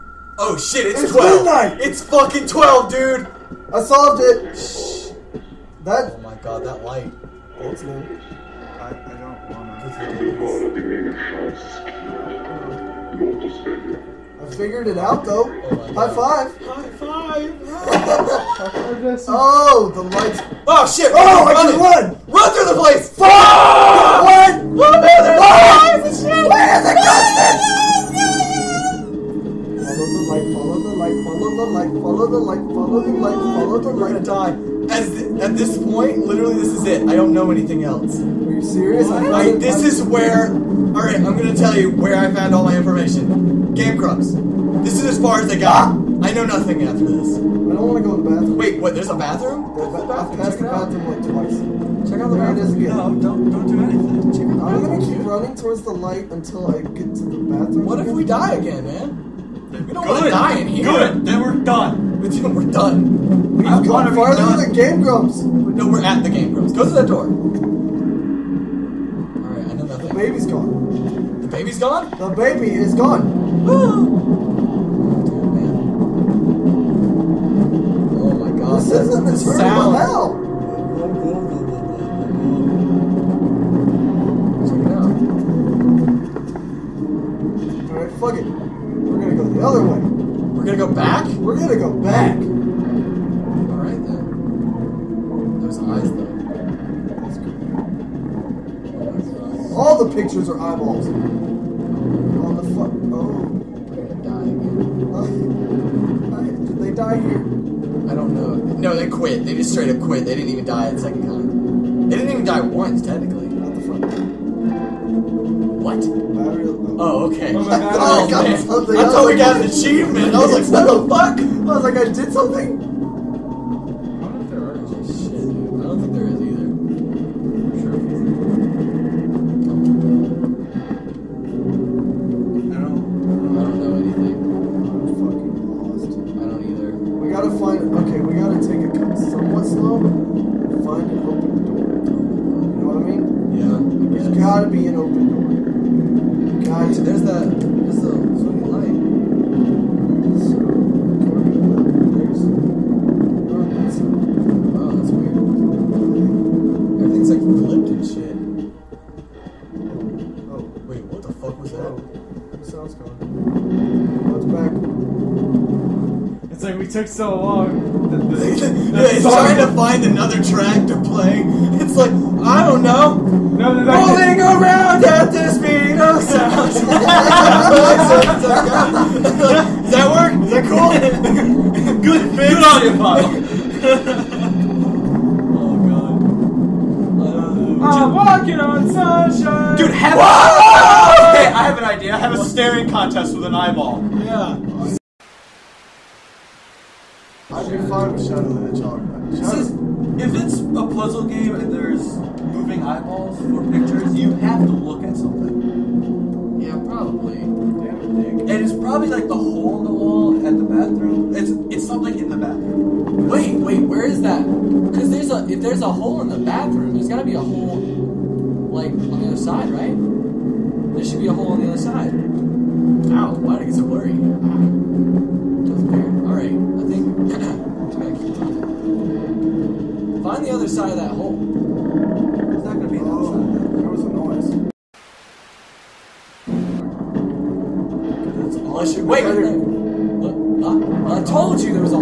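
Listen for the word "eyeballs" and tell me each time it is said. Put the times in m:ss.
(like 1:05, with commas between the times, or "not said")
1:40, 3:13, 3:22.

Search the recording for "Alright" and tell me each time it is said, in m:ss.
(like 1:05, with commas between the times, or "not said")
0:40, 1:33.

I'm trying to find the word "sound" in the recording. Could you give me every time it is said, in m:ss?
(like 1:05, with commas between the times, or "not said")
1:19, 2:56.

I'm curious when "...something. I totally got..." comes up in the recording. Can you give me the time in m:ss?
1:58.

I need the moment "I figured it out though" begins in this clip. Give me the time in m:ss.
0:14.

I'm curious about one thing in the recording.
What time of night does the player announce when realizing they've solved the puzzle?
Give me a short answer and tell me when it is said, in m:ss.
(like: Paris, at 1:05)
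Midnight, at 0:01.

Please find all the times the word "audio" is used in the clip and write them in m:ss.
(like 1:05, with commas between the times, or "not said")
3:02.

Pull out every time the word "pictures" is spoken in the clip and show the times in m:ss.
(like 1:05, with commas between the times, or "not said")
1:40, 3:23.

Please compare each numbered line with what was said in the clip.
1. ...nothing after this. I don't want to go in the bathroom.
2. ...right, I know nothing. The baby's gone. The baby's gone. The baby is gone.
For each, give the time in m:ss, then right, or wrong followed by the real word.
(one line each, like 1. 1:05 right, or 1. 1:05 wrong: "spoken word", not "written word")
1. 0:46 right
2. 1:09 right.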